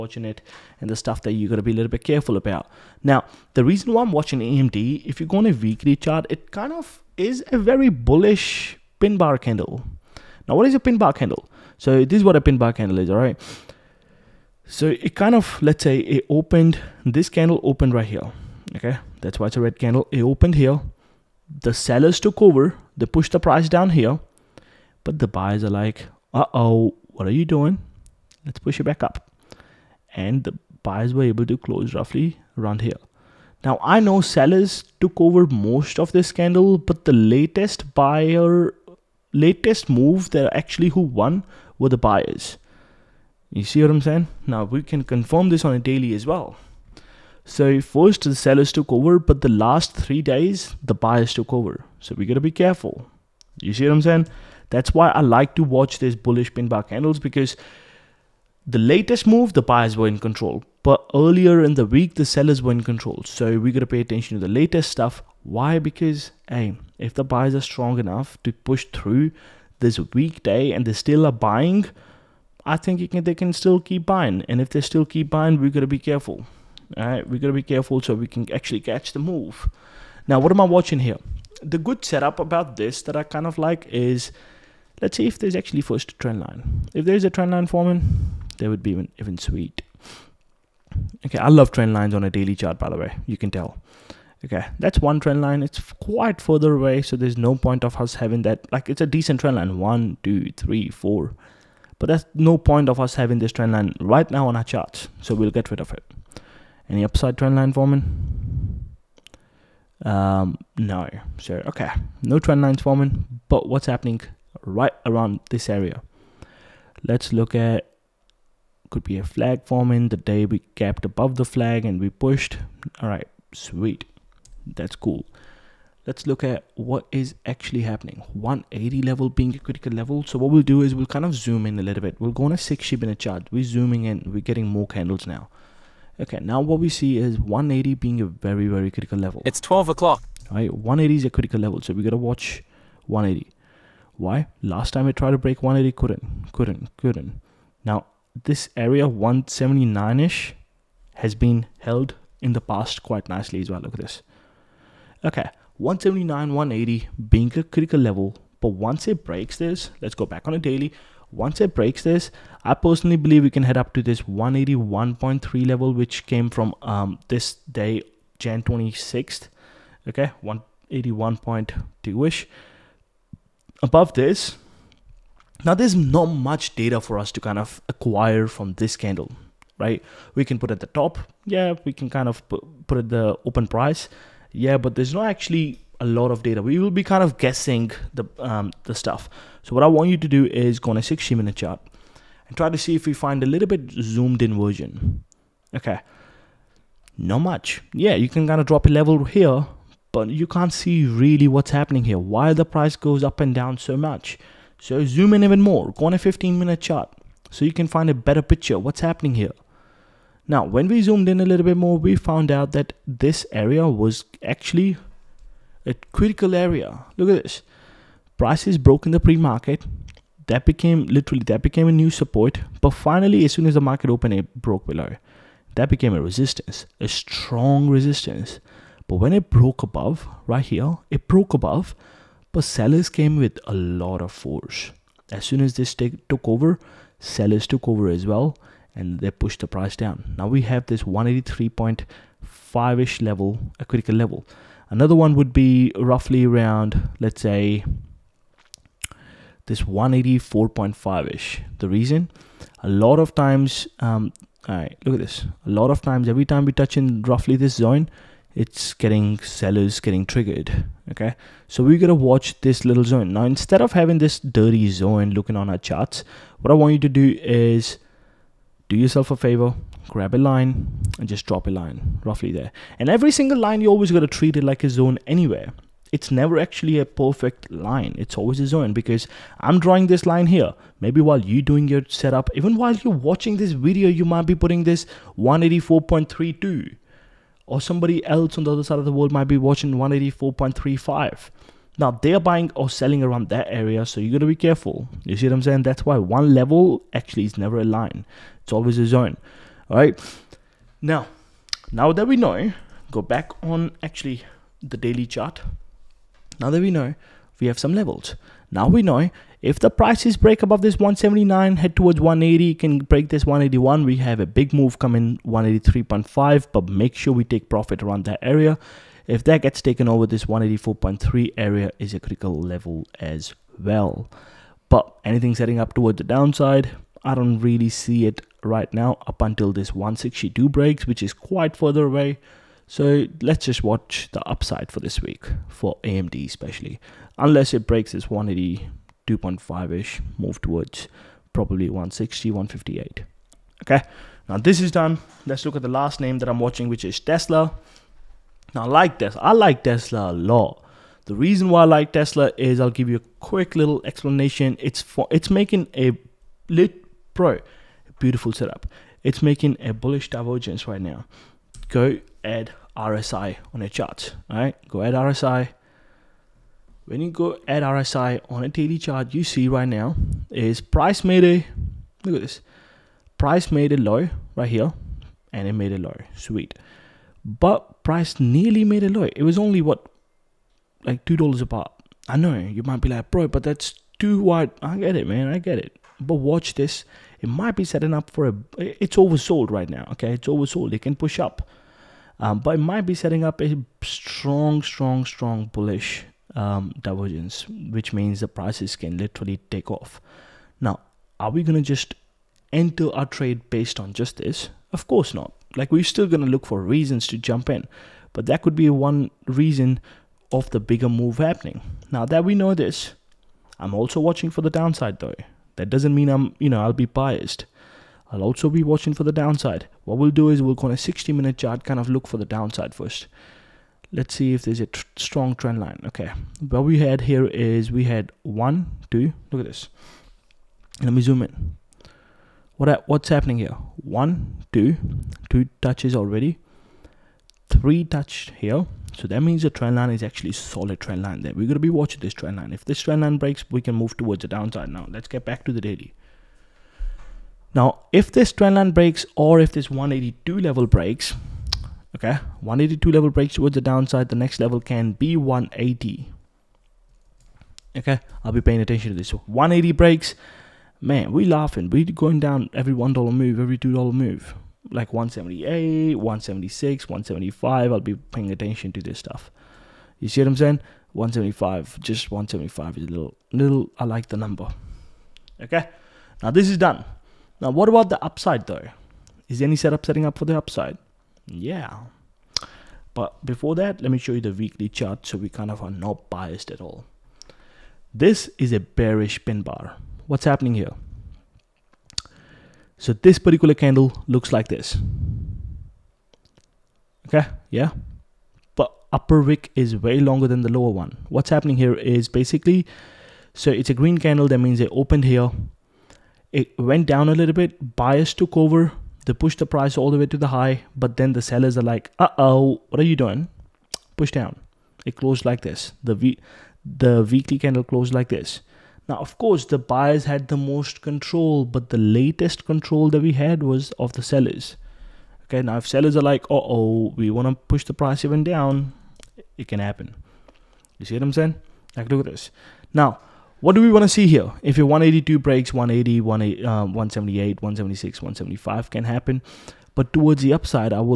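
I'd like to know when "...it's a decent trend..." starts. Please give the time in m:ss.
1:38.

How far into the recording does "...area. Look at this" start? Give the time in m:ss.
3:36.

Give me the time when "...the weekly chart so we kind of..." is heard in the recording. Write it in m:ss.
8:04.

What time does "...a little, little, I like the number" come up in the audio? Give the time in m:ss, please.
7:53.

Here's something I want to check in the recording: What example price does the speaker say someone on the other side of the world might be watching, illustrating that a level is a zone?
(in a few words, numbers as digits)
184.35.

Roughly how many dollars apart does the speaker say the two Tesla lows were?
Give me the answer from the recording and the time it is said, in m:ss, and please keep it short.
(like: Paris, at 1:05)
2 dollars, at 6:21.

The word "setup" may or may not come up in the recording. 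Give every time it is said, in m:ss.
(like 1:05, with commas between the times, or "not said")
1:22, 4:42, 5:58, 7:59.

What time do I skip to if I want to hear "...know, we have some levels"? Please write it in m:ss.
5:06.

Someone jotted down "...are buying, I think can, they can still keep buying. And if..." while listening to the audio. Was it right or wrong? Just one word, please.
right.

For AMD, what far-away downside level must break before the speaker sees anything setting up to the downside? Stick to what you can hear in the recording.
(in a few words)
162.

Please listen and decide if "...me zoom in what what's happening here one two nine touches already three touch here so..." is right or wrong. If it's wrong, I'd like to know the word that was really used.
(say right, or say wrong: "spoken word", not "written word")
wrong: "two", not "nine".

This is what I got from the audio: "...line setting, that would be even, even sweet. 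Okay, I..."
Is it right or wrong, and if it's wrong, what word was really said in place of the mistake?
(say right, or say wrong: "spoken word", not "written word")
wrong: "forming", not "setting".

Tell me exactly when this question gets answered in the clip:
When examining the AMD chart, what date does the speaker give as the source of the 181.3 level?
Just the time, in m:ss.
2:48.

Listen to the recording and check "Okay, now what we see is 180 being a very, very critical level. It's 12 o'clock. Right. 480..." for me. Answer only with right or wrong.
wrong.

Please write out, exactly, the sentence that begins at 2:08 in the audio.
180 level being a critical level.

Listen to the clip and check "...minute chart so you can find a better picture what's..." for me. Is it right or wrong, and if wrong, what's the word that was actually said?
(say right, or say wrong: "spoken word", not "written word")
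right.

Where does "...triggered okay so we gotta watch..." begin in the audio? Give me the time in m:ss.
4:20.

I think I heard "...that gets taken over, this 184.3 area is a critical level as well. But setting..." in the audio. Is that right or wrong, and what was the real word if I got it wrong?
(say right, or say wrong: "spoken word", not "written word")
wrong: "anything", not "setting".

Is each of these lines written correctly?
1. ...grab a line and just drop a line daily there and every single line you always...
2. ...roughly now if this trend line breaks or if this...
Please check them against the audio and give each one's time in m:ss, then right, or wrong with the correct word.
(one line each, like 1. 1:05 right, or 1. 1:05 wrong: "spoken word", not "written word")
1. 4:30 wrong: "roughly", not "daily"
2. 7:25 wrong: "daily", not "roughly".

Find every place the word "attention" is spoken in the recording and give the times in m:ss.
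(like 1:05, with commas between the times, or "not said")
1:04, 7:38, 7:48.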